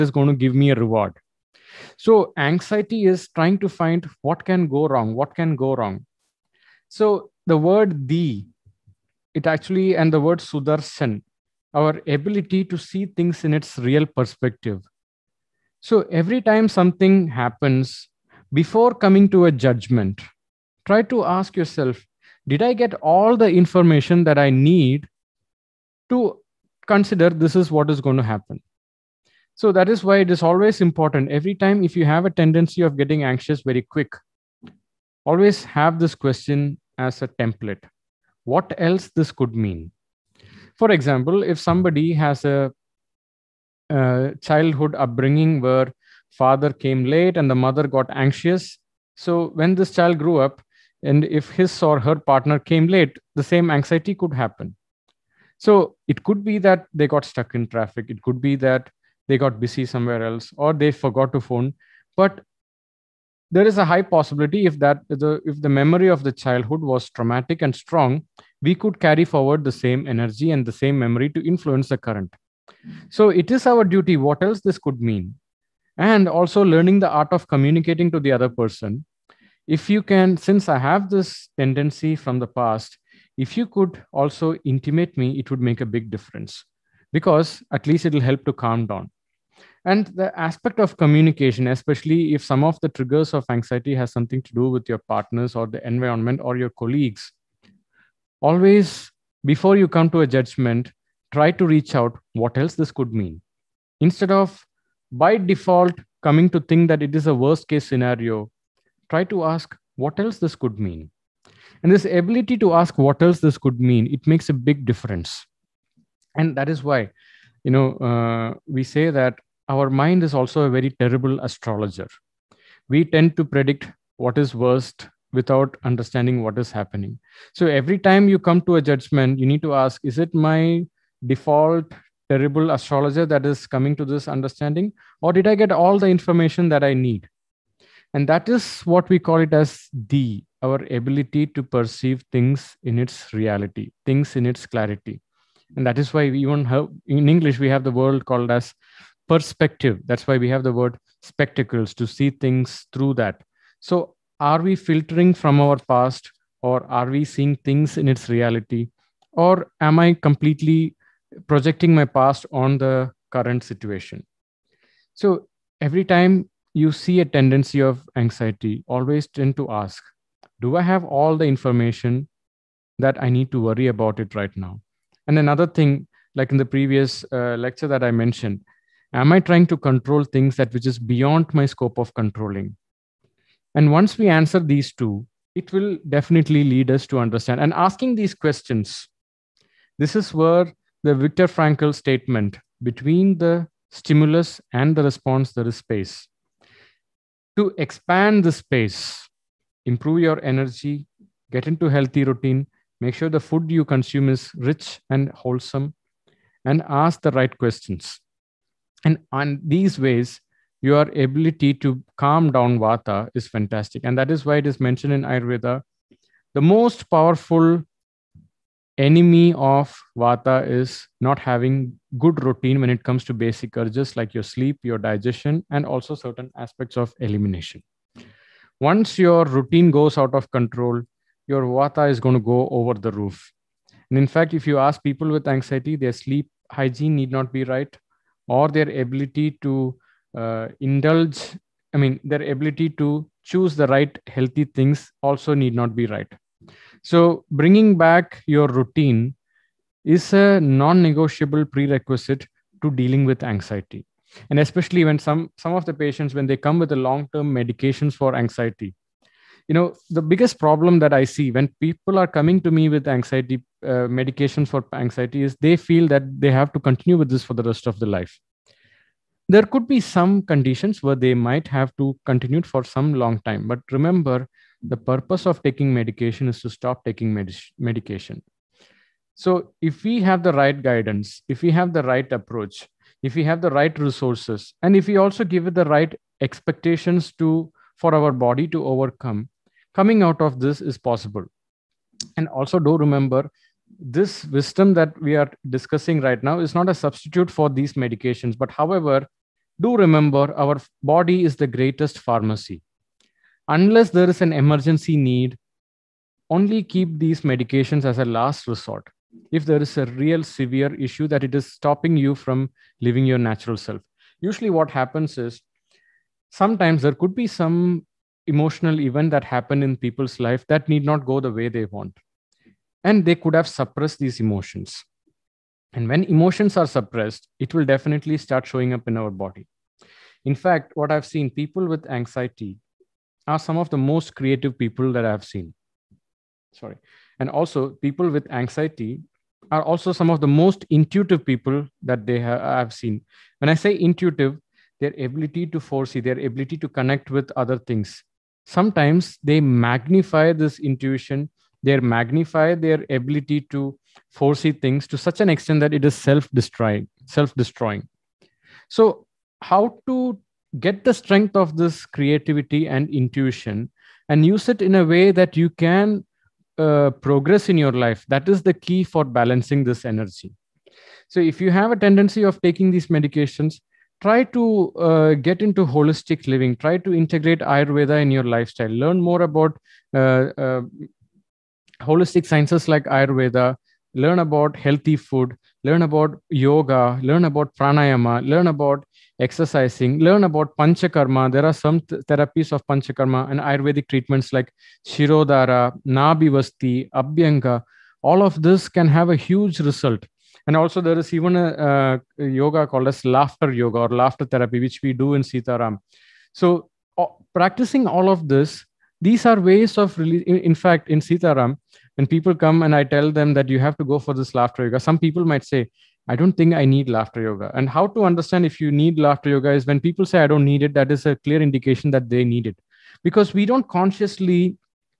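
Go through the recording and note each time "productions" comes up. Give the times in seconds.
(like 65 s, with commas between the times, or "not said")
not said.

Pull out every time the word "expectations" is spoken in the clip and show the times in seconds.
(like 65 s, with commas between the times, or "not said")
286 s.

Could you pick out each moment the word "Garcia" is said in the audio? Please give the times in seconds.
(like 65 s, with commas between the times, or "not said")
not said.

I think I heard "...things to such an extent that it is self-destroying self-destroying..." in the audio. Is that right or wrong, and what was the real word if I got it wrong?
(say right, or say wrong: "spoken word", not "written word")
right.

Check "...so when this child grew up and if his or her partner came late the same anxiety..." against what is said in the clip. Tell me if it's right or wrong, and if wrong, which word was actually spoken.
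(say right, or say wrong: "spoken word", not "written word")
right.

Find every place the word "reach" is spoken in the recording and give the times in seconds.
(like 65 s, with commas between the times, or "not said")
101 s.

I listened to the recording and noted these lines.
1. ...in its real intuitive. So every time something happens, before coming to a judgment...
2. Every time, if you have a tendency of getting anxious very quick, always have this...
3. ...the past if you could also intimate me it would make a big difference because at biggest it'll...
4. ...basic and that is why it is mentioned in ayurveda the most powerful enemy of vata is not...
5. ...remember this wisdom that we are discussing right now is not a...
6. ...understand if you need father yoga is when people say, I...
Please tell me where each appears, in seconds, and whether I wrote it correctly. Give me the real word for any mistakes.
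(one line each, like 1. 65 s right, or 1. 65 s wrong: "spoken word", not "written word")
1. 13 s wrong: "perspective", not "intuitive"
2. 31 s right
3. 82 s wrong: "least", not "biggest"
4. 213 s wrong: "fantastic", not "basic"
5. 292 s right
6. 418 s wrong: "laughter", not "father".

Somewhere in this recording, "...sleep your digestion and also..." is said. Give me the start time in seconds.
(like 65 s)
224 s.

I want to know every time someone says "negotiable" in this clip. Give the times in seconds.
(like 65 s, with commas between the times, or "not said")
250 s.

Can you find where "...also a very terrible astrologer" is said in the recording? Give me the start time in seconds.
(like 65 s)
120 s.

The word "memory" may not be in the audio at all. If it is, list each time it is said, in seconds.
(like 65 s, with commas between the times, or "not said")
65 s, 70 s.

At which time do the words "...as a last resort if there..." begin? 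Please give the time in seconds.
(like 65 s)
308 s.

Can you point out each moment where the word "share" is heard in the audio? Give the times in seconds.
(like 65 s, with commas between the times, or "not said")
not said.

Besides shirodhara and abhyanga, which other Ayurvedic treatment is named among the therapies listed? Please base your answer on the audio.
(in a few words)
nabivasti.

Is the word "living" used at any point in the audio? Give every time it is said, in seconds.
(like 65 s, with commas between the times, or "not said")
313 s, 376 s.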